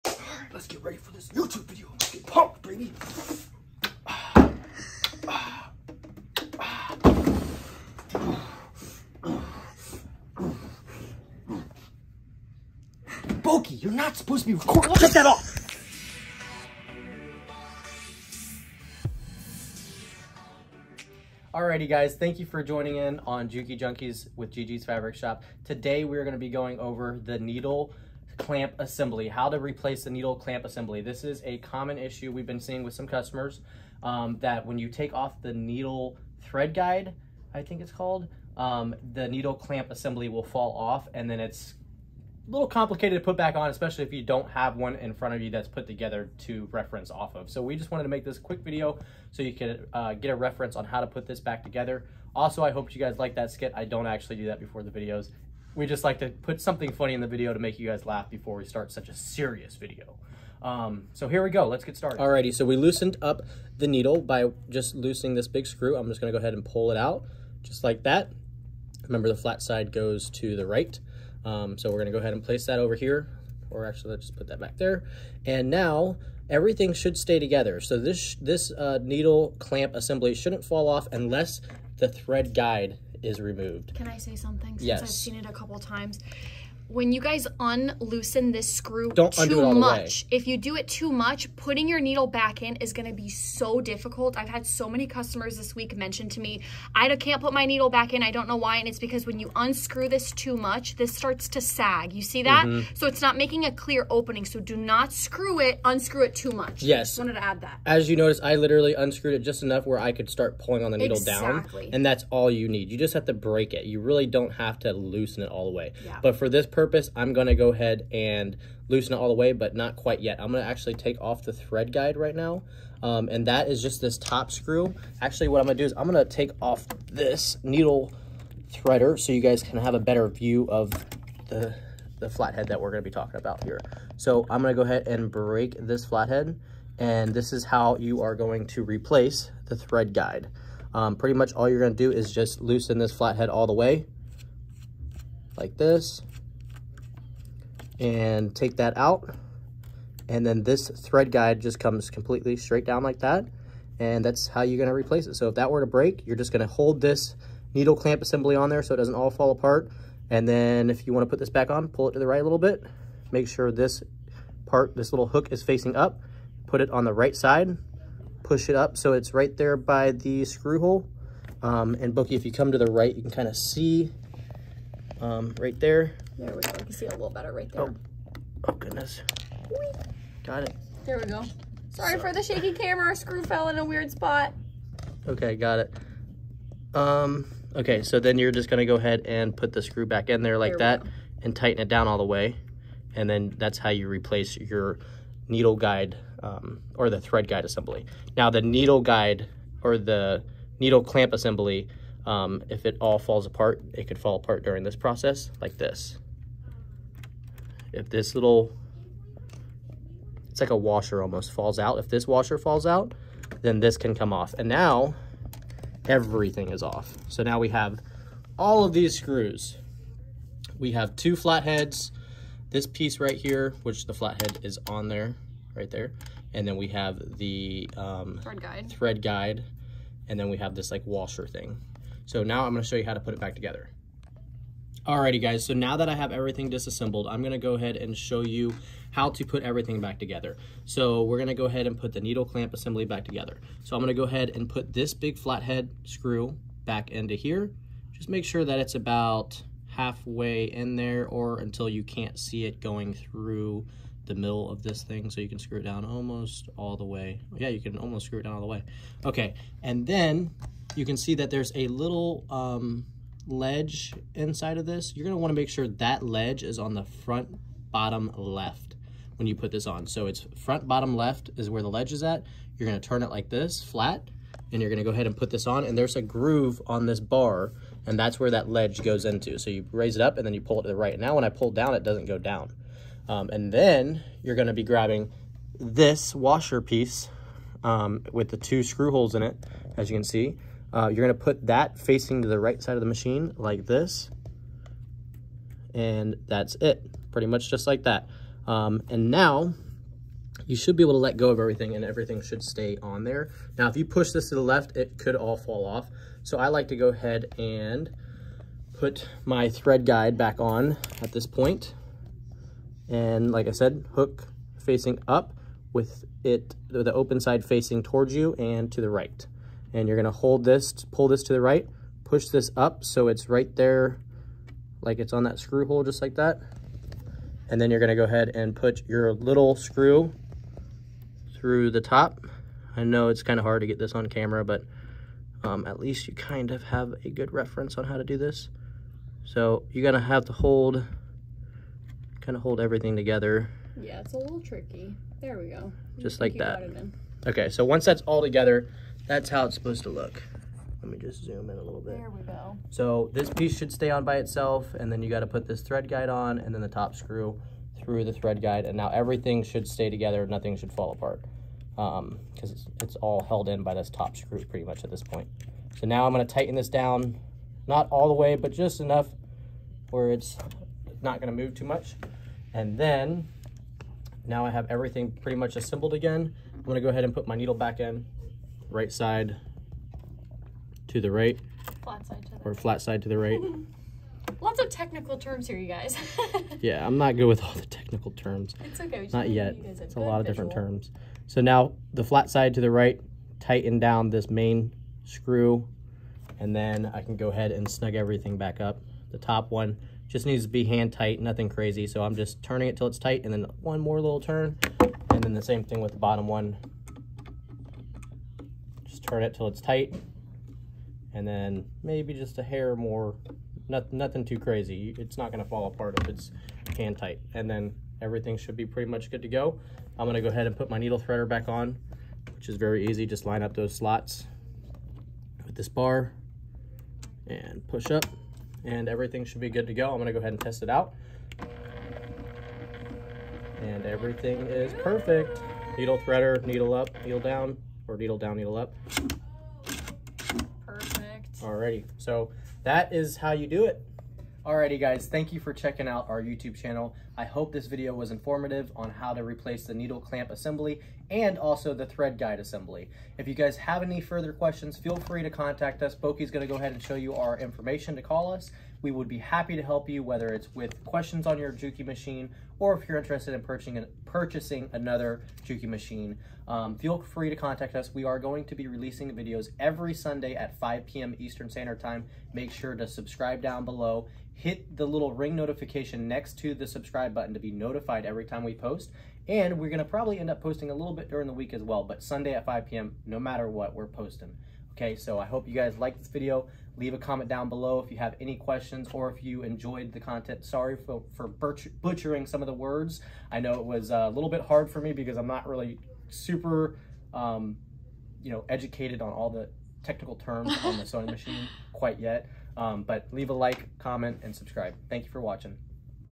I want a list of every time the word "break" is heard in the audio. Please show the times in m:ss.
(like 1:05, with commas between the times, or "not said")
1:53, 2:15, 2:35.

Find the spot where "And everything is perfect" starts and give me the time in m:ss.
7:13.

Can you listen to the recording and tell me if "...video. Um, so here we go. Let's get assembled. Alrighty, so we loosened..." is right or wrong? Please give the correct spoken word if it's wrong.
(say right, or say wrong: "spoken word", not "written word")
wrong: "started", not "assembled".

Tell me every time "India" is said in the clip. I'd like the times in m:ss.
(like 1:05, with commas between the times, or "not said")
not said.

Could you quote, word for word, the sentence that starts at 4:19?
Okay, and then you can see that there's a little um, ledge inside of this.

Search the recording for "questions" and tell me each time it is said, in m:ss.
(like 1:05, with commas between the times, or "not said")
7:34, 7:41, 8:08.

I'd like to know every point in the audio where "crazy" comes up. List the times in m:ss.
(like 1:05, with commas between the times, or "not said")
6:41, 6:54.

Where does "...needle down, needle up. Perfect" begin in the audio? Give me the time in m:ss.
7:18.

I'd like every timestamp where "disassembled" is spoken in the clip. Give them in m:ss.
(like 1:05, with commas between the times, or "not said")
3:56.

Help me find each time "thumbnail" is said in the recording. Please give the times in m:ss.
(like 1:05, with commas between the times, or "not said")
not said.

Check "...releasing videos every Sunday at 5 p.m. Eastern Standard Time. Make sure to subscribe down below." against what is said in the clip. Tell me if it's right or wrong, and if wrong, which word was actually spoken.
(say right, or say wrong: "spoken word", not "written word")
right.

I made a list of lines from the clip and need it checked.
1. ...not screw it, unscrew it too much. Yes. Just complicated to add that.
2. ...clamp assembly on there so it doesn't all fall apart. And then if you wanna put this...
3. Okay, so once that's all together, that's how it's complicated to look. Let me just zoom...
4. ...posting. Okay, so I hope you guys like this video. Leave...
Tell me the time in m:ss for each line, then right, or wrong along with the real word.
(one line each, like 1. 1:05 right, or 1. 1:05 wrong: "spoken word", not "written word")
1. 1:44 wrong: "wanted", not "complicated"
2. 2:37 right
3. 5:47 wrong: "supposed", not "complicated"
4. 8:04 right.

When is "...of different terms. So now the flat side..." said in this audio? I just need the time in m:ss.
6:30.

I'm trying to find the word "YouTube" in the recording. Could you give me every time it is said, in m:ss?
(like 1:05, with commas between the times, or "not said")
0:01, 7:26.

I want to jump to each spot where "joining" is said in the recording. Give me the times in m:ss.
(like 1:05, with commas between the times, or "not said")
0:22.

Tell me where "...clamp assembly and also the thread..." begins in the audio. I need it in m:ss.
7:30.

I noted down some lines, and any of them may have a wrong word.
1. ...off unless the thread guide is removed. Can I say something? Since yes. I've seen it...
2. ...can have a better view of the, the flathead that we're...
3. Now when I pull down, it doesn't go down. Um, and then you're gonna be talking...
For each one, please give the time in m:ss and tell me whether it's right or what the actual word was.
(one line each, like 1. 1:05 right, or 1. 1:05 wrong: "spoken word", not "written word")
1. 1:20 right
2. 2:09 right
3. 4:41 wrong: "grabbing", not "talking".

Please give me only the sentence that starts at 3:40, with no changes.
We have two flatheads, this piece right here, which the flathead is on there, right there.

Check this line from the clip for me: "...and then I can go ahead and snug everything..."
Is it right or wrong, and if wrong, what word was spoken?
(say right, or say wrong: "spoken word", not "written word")
right.